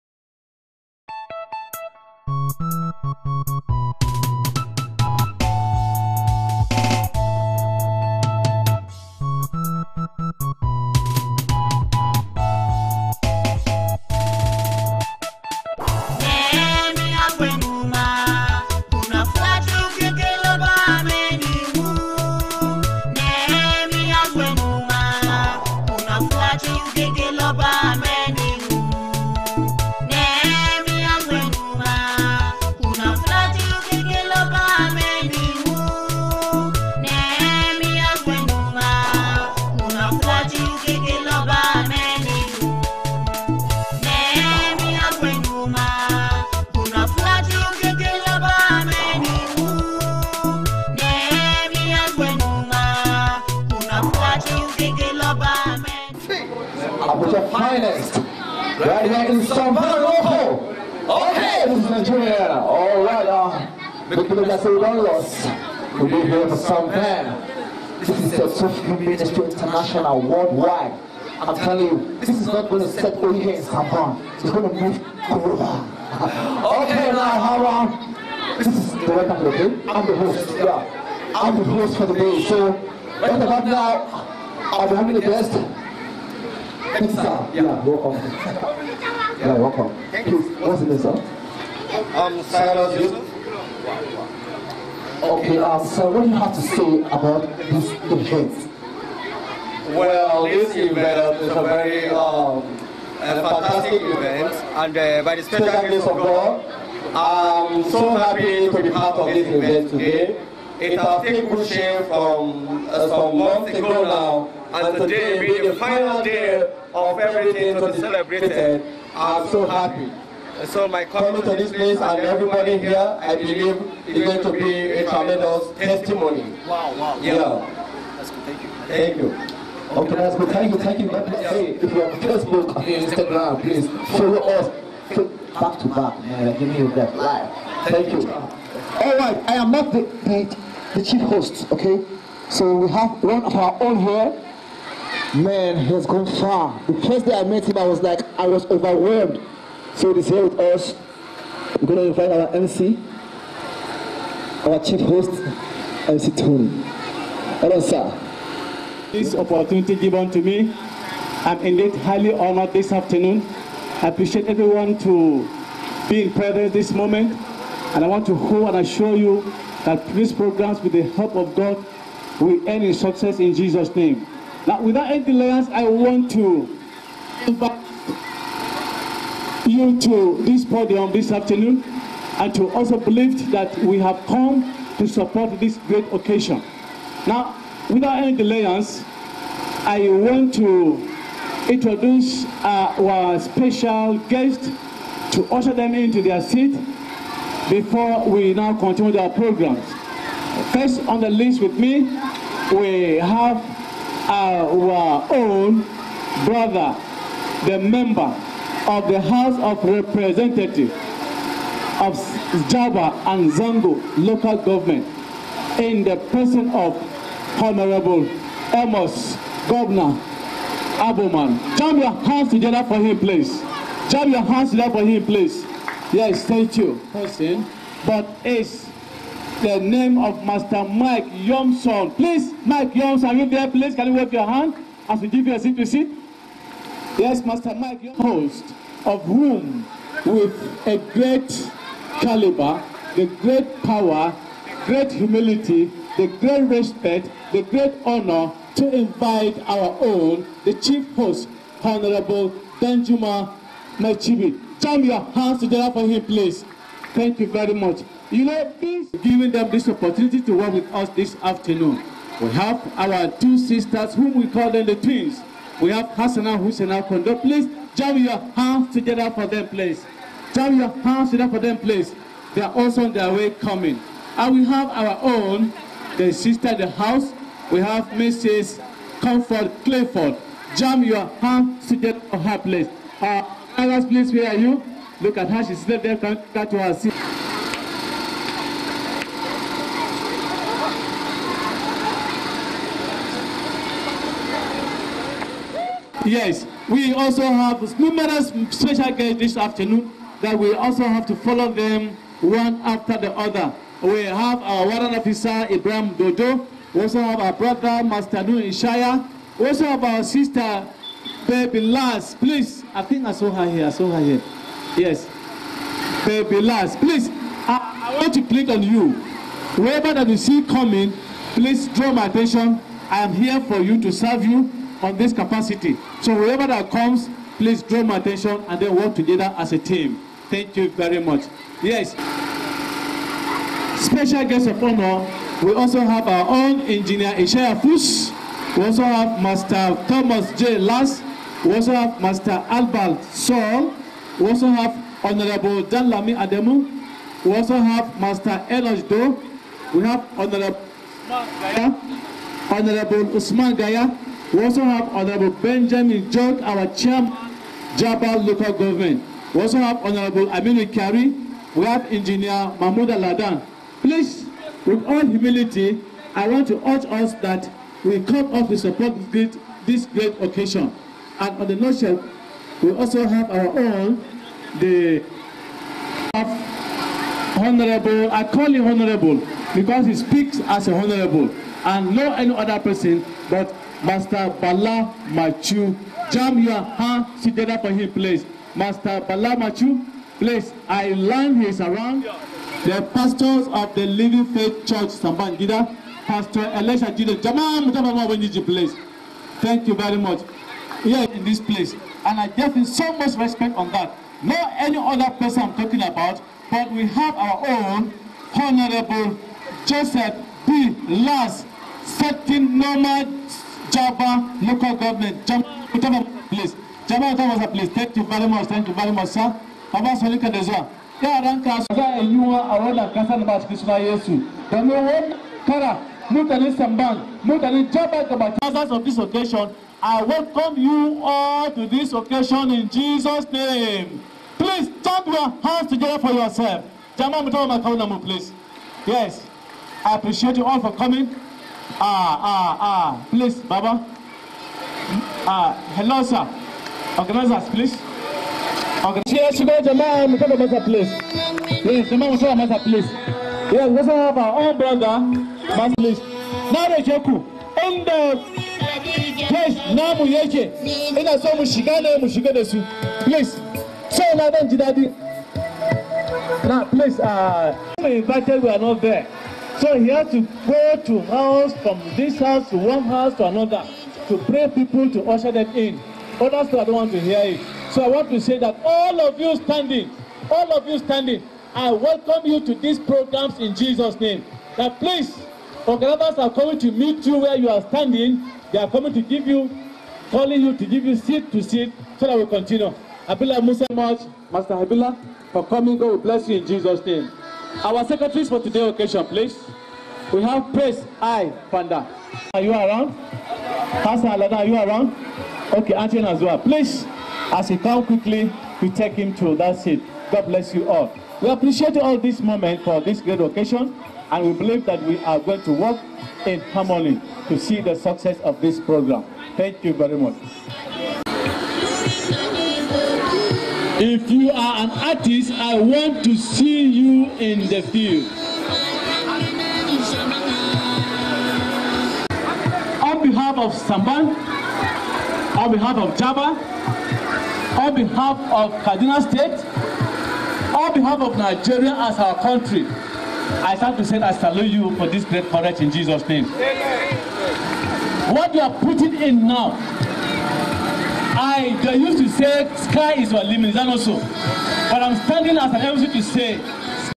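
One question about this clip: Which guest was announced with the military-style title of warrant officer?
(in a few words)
Ibrahim Dodo.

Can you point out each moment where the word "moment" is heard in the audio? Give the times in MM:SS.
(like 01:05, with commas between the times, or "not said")
02:46, 08:32.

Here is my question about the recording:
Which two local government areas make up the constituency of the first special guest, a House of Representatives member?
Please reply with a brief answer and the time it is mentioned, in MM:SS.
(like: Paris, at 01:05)
Jaba and Zango, at 03:32.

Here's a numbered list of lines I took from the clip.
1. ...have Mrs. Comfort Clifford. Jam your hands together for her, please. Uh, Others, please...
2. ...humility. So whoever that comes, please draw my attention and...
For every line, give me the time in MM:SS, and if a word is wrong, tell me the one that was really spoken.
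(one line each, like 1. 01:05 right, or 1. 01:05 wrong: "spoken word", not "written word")
1. 04:37 right
2. 05:25 wrong: "capacity", not "humility".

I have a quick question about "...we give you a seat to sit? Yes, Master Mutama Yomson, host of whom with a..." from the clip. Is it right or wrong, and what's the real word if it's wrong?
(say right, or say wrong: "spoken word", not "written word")
wrong: "Mike", not "Mutama".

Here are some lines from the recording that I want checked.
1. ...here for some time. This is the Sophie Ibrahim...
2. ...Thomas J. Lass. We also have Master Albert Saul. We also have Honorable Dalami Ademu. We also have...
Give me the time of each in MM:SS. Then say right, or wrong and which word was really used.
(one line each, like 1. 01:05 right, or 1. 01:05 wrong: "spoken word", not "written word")
1. 01:06 wrong: "Ministry", not "Ibrahim"
2. 05:40 right.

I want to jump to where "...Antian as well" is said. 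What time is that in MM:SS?
08:25.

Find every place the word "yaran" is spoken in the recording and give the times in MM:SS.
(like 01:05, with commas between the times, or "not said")
07:01.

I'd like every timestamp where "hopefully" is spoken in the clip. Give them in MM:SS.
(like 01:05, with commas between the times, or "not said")
not said.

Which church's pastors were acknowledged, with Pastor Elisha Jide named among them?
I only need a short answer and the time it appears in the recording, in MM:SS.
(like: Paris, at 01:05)
Living Faith Church, at 06:34.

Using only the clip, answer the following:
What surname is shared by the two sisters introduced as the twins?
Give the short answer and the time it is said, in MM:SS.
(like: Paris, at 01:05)
Kondo, at 04:27.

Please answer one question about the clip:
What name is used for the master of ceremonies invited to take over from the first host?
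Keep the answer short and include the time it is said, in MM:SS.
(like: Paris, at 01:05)
MC Tony, at 02:36.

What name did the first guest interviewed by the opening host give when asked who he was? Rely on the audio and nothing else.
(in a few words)
Cyrus Joseph.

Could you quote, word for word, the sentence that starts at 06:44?
Not any other person I'm talking about, but we have our own Honorable Joseph B.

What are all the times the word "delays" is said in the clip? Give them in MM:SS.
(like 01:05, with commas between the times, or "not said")
02:55, 03:08.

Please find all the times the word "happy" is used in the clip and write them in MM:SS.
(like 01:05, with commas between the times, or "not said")
01:48, 01:59.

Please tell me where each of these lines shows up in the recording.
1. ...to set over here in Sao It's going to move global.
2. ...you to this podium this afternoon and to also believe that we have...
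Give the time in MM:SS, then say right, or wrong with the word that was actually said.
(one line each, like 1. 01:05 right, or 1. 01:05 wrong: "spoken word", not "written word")
1. 01:12 right
2. 02:59 right.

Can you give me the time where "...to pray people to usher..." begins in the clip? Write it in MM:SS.
07:54.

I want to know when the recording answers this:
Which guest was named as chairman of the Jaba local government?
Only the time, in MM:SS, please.
05:55.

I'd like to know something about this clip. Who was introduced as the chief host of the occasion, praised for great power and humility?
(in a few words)
Danjuma Machibi.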